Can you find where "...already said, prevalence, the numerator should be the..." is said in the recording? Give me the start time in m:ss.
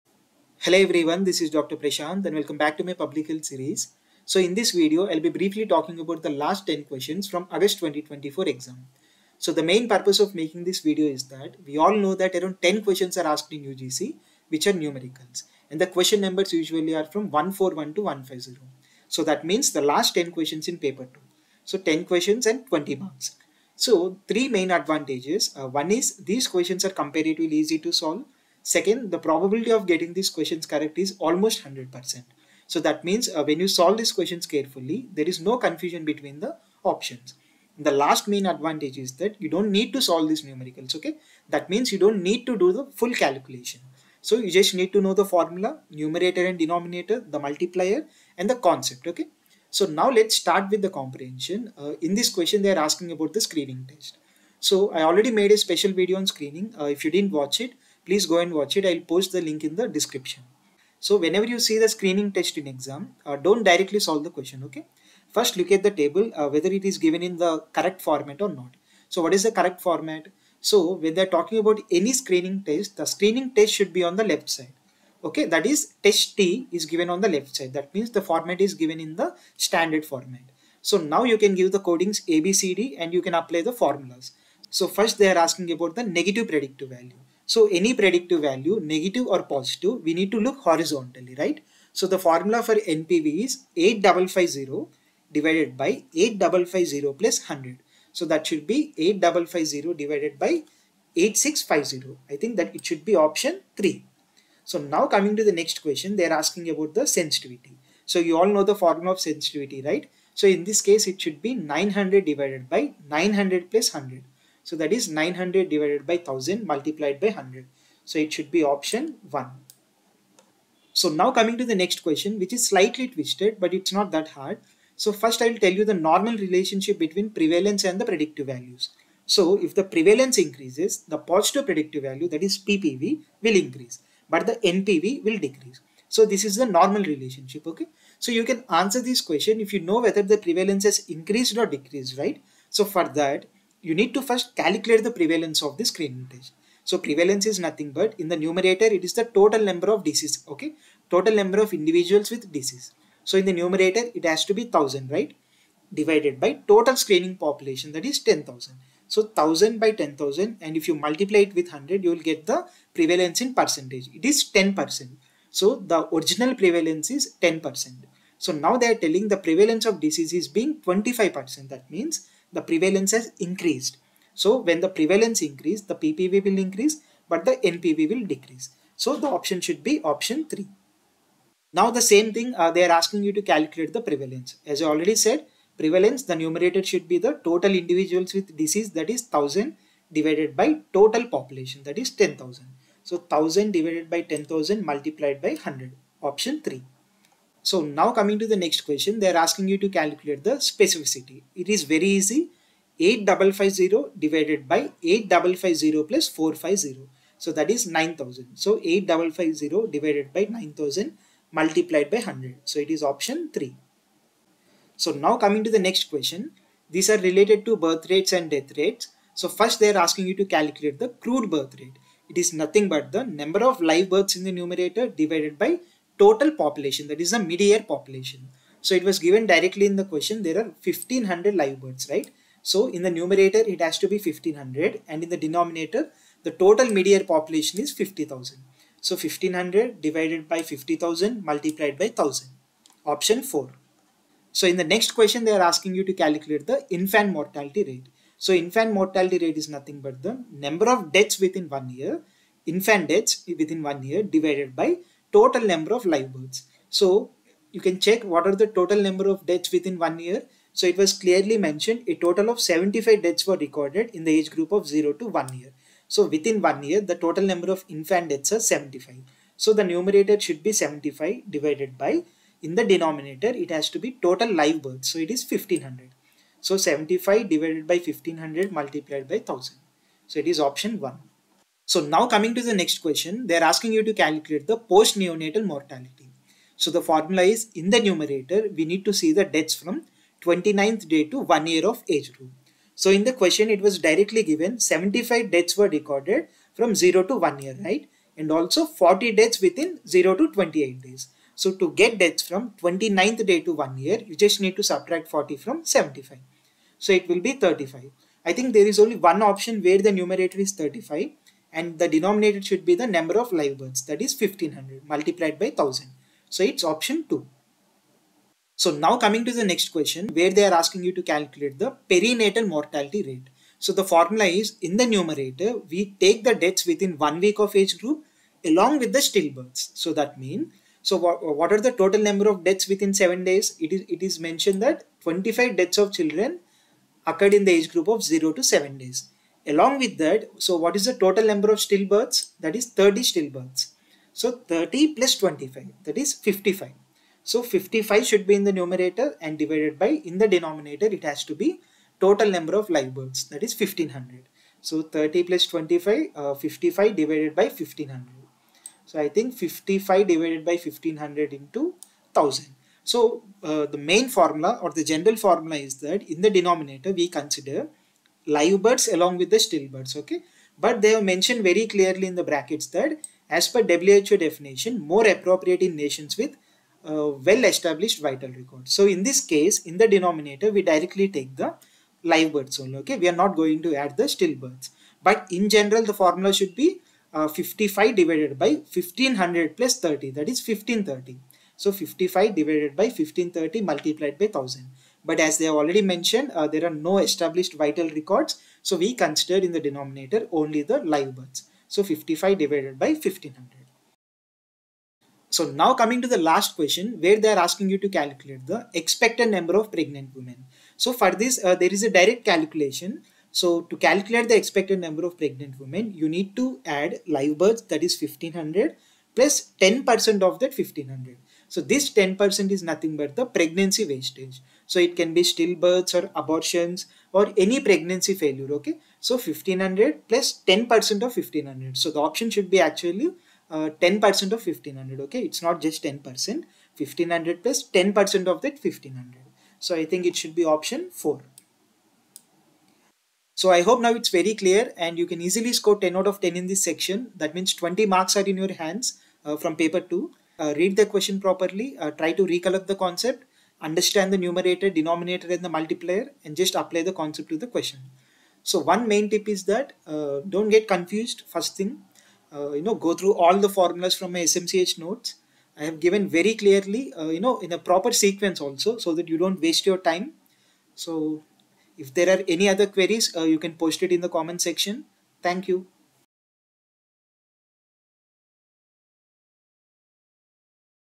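3:04.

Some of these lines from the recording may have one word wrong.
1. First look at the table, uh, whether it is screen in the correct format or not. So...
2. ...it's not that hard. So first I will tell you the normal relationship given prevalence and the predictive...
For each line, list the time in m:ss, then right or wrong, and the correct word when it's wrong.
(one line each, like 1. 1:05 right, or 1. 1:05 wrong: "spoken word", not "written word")
1. 1:05 wrong: "given", not "screen"
2. 2:03 wrong: "between", not "given".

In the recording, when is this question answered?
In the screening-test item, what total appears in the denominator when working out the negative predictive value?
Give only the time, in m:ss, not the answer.
1:38.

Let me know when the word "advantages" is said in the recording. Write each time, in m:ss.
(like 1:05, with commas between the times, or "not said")
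0:24, 0:38.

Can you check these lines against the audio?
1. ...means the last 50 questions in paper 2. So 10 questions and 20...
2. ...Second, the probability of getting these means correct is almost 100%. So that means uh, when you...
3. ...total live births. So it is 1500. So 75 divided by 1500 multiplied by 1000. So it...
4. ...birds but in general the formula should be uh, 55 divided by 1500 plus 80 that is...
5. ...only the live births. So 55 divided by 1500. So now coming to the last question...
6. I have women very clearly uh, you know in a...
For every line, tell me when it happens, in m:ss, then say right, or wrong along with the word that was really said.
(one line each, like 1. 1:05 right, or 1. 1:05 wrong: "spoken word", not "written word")
1. 0:19 wrong: "10", not "50"
2. 0:28 wrong: "questions", not "means"
3. 4:34 right
4. 6:24 wrong: "30", not "80"
5. 6:40 right
6. 7:45 wrong: "given", not "women".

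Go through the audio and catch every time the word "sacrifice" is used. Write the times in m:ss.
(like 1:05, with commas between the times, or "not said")
not said.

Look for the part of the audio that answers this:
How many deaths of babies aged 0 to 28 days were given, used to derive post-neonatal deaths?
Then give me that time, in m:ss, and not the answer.
4:58.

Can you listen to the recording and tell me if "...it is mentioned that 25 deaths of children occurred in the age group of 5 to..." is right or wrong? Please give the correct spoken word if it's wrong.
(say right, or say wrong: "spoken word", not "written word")
wrong: "0", not "5".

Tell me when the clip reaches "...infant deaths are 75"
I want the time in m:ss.
4:27.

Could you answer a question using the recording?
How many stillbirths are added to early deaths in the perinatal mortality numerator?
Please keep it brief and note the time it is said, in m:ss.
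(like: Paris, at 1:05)
30, at 5:42.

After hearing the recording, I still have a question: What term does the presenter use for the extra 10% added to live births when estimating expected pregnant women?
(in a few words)
pregnancy wastage.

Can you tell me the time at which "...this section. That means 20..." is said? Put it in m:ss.
7:26.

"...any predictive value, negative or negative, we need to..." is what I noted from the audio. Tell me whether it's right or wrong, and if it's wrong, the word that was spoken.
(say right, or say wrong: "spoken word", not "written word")
wrong: "positive", not "negative".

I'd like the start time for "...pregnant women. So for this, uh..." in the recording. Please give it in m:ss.
6:49.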